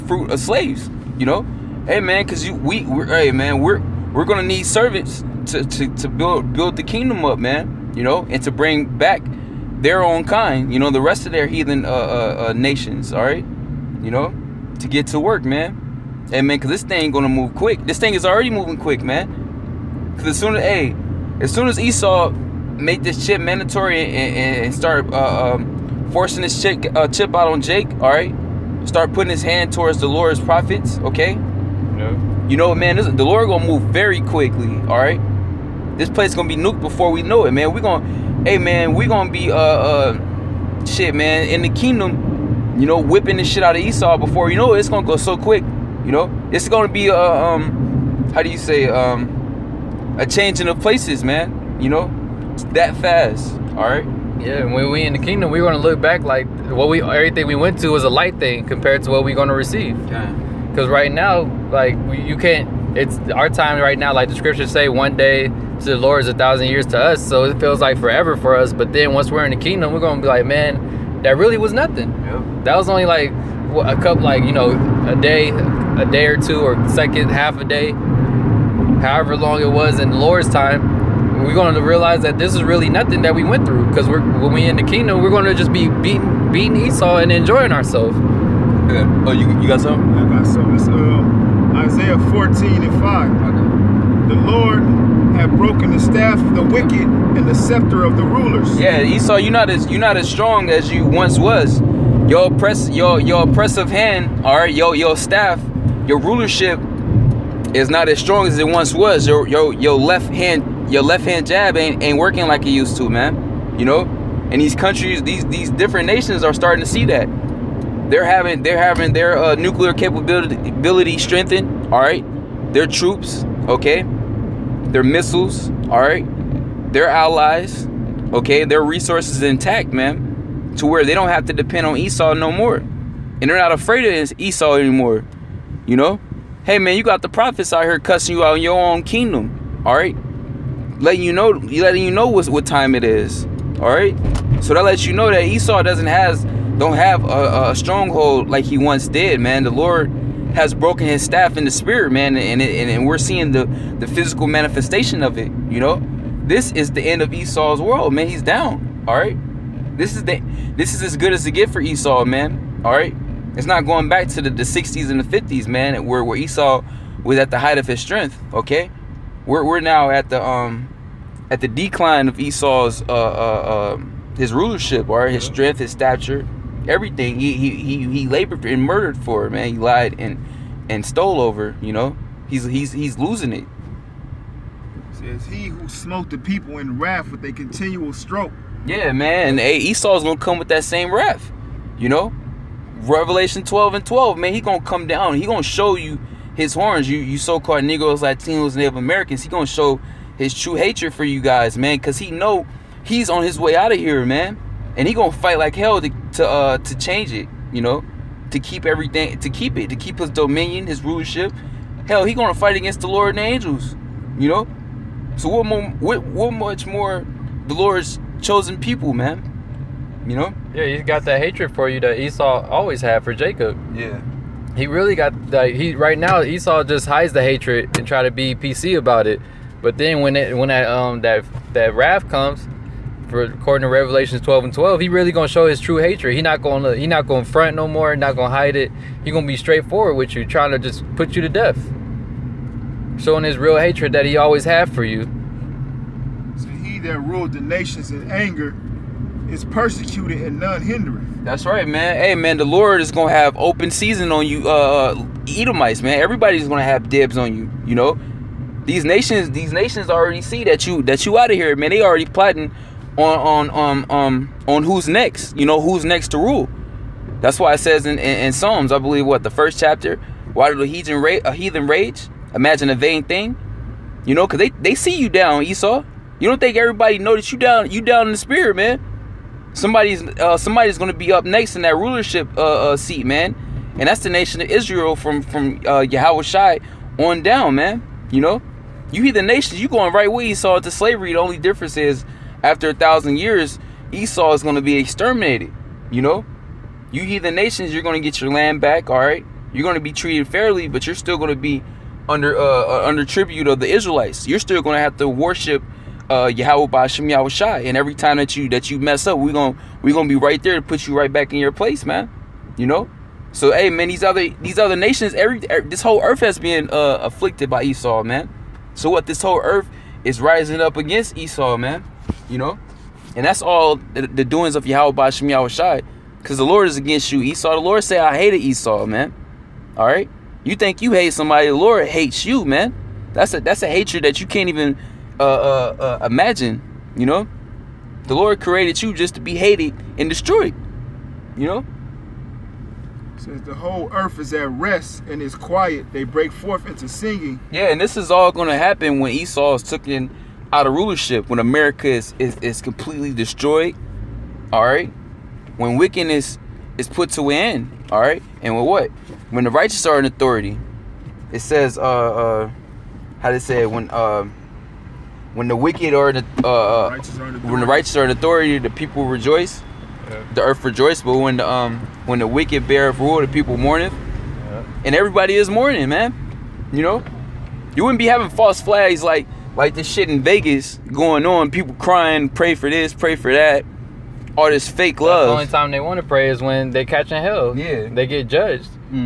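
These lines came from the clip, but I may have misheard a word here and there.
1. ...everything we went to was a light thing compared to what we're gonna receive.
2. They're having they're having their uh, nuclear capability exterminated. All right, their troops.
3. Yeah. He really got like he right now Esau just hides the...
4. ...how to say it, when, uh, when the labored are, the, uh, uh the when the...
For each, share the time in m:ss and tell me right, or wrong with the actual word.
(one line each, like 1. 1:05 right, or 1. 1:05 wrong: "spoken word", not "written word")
1. 0:57 right
2. 1:58 wrong: "strengthened", not "exterminated"
3. 3:43 right
4. 6:03 wrong: "wicked", not "labored".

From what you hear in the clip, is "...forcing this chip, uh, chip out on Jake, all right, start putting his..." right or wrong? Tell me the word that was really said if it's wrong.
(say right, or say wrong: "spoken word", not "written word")
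right.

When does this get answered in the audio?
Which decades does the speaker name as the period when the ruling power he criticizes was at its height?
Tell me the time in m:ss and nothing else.
2:44.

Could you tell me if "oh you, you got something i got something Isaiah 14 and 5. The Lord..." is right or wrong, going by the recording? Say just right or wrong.
right.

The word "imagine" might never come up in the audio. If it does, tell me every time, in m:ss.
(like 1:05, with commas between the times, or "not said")
4:32, 5:36.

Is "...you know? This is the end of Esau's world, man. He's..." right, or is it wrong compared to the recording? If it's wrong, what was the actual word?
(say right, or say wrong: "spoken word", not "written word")
right.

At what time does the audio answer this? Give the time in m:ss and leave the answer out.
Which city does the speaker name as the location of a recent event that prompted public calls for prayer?
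6:20.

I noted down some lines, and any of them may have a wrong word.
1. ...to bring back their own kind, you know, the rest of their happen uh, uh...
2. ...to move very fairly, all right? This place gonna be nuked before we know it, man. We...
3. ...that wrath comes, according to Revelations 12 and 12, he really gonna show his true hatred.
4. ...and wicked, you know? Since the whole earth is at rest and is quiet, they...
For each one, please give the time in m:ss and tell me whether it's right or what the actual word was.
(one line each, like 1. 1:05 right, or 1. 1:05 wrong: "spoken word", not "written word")
1. 0:08 wrong: "heathen", not "happen"
2. 0:33 wrong: "quickly", not "fairly"
3. 3:51 right
4. 5:40 wrong: "destroyed", not "wicked".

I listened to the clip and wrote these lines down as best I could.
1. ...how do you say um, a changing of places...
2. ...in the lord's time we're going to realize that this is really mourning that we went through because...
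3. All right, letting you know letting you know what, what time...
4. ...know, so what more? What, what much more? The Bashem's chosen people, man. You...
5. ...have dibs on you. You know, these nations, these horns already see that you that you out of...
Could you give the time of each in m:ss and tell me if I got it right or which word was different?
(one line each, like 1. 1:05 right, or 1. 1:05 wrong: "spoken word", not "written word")
1. 0:48 right
2. 1:20 wrong: "nothing", not "mourning"
3. 2:19 right
4. 3:34 wrong: "Lord", not "Bashem"
5. 4:16 wrong: "nations", not "horns".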